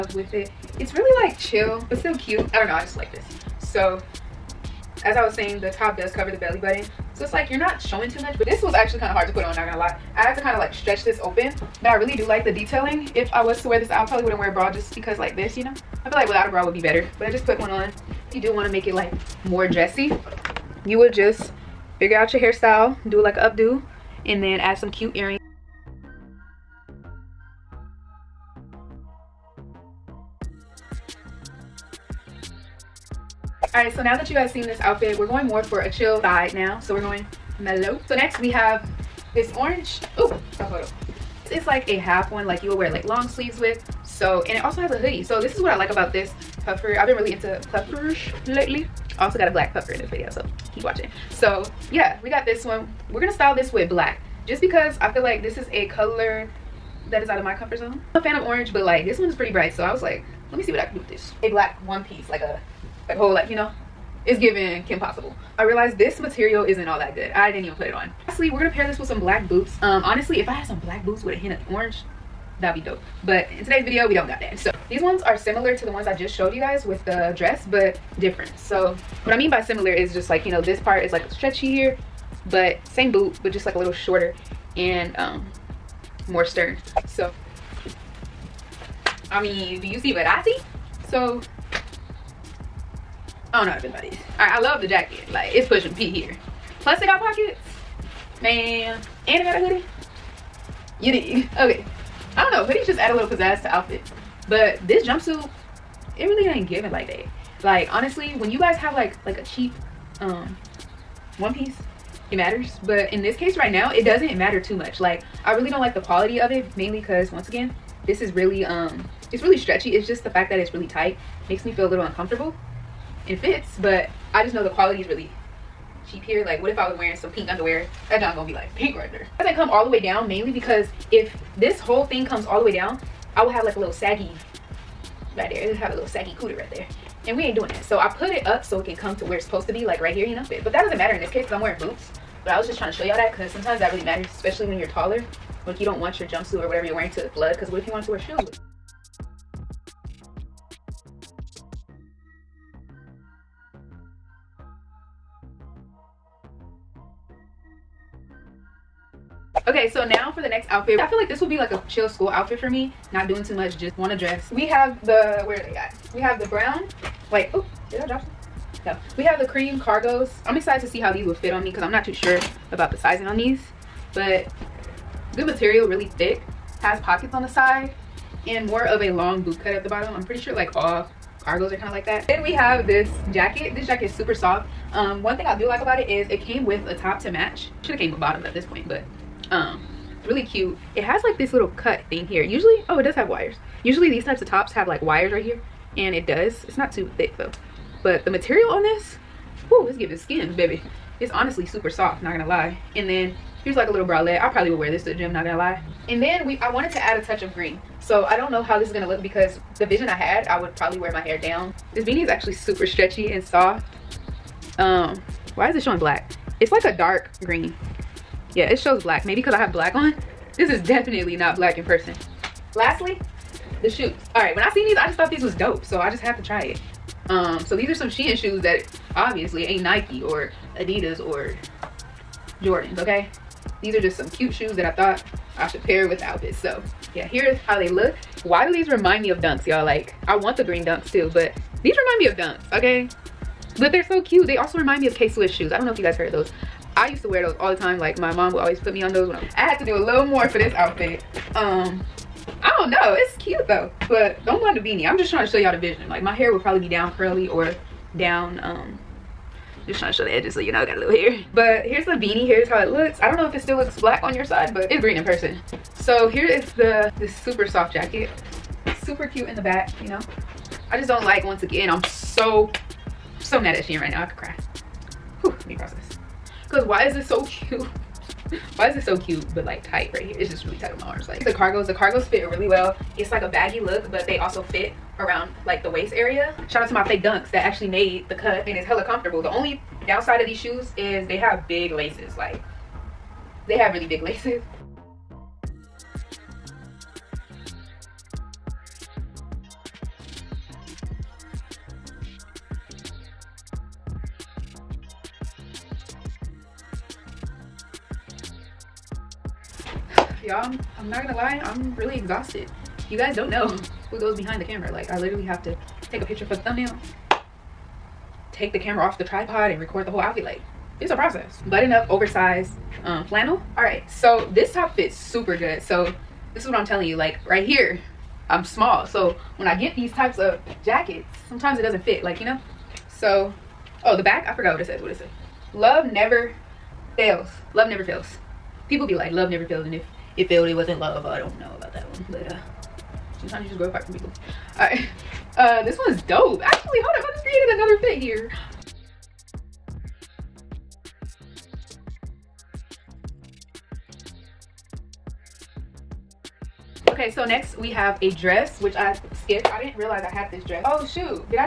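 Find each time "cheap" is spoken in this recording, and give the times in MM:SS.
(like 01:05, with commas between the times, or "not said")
01:49, 02:06.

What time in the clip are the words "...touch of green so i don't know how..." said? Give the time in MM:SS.
03:27.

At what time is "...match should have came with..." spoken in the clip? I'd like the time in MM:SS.
03:07.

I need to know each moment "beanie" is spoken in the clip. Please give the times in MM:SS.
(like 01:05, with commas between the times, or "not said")
03:32, 04:14, 04:22.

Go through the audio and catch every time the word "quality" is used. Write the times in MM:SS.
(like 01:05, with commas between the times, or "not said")
01:55, 02:04.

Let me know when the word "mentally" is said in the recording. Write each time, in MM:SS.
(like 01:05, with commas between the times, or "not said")
not said.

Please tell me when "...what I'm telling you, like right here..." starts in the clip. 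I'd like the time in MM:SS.
05:26.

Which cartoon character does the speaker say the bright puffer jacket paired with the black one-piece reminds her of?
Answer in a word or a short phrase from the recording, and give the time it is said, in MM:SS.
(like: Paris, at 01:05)
Kim Possible, at 01:04.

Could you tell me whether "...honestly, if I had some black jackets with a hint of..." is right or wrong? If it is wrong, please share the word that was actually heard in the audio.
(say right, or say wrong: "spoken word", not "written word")
wrong: "boots", not "jackets".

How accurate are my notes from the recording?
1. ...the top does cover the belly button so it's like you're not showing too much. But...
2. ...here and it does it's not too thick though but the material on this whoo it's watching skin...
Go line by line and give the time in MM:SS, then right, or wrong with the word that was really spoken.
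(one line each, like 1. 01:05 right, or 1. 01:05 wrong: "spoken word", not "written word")
1. 00:05 right
2. 03:15 wrong: "giving", not "watching".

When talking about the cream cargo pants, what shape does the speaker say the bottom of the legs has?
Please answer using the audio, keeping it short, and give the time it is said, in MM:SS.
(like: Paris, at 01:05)
long boot cut, at 02:59.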